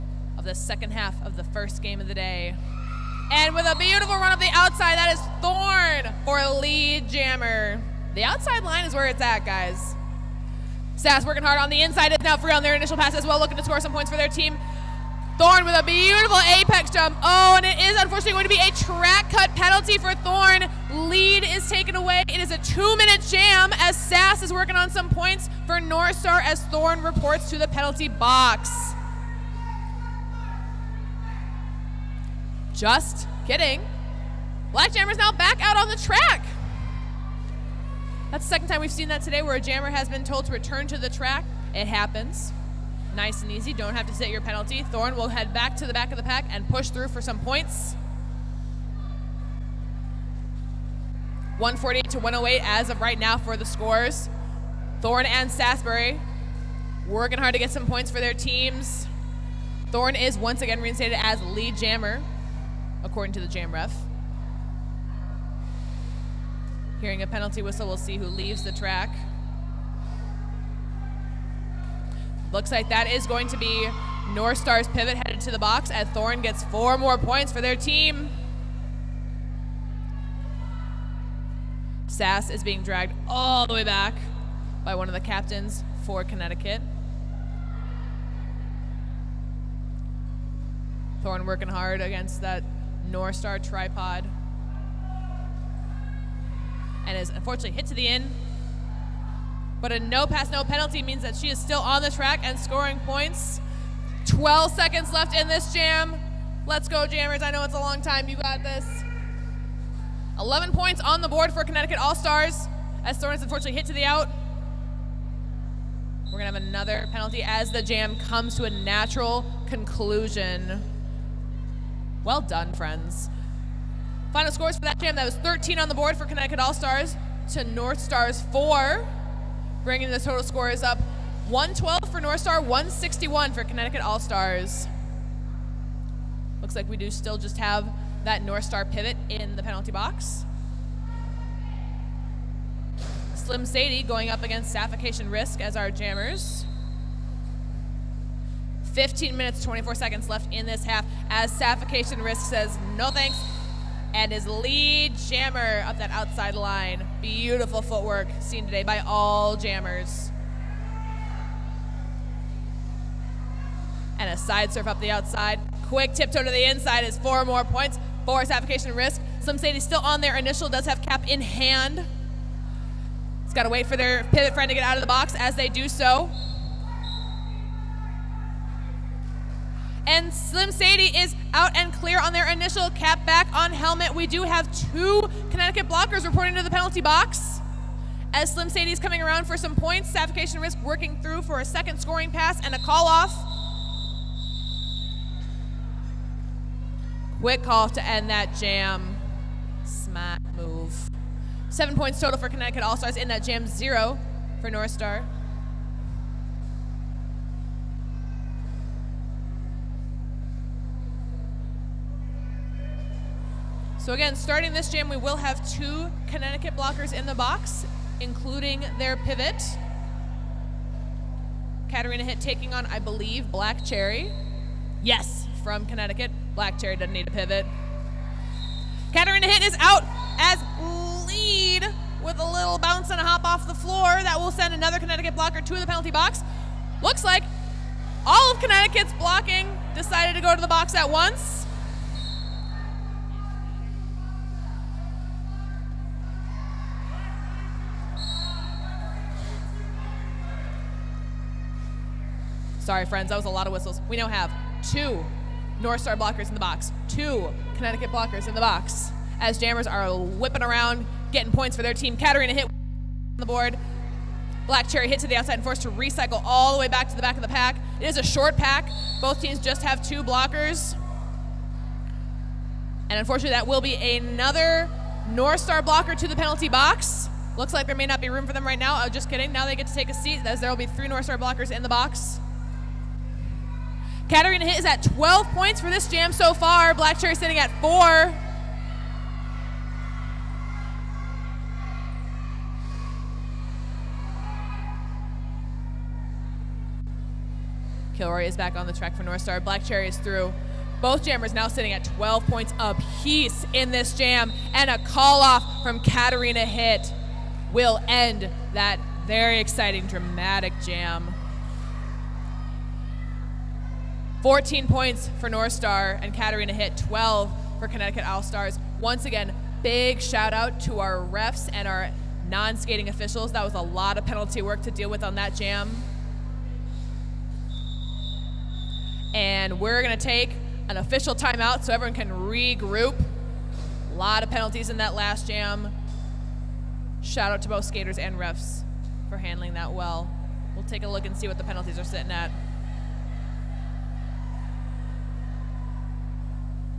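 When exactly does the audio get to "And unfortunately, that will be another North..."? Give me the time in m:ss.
4:33.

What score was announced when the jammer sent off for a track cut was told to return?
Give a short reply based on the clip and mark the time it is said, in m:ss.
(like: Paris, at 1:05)
148 to 108, at 0:51.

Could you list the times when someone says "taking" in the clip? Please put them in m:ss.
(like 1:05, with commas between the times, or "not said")
3:42.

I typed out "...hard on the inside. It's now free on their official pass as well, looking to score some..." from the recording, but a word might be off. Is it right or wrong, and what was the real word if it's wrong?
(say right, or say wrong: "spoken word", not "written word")
wrong: "initial", not "official".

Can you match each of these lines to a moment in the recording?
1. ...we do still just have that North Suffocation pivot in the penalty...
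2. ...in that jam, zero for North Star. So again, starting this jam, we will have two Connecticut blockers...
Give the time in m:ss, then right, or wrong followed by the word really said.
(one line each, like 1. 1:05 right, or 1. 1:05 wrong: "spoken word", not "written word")
1. 2:16 wrong: "Star", not "Suffocation"
2. 3:23 right.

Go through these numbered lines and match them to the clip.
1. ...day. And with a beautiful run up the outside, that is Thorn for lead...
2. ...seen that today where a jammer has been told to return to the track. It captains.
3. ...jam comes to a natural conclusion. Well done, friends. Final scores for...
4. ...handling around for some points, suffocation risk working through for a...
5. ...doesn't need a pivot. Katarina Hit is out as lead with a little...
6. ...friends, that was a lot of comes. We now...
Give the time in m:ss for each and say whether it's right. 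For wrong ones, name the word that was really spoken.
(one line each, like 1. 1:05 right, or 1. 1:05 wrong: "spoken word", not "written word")
1. 0:02 right
2. 0:38 wrong: "happens", not "captains"
3. 1:57 right
4. 3:08 wrong: "coming", not "handling"
5. 3:46 right
6. 4:13 wrong: "whistles", not "comes".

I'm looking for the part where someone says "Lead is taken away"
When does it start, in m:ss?
0:21.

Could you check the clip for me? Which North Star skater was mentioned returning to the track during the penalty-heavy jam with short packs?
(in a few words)
Kilroy.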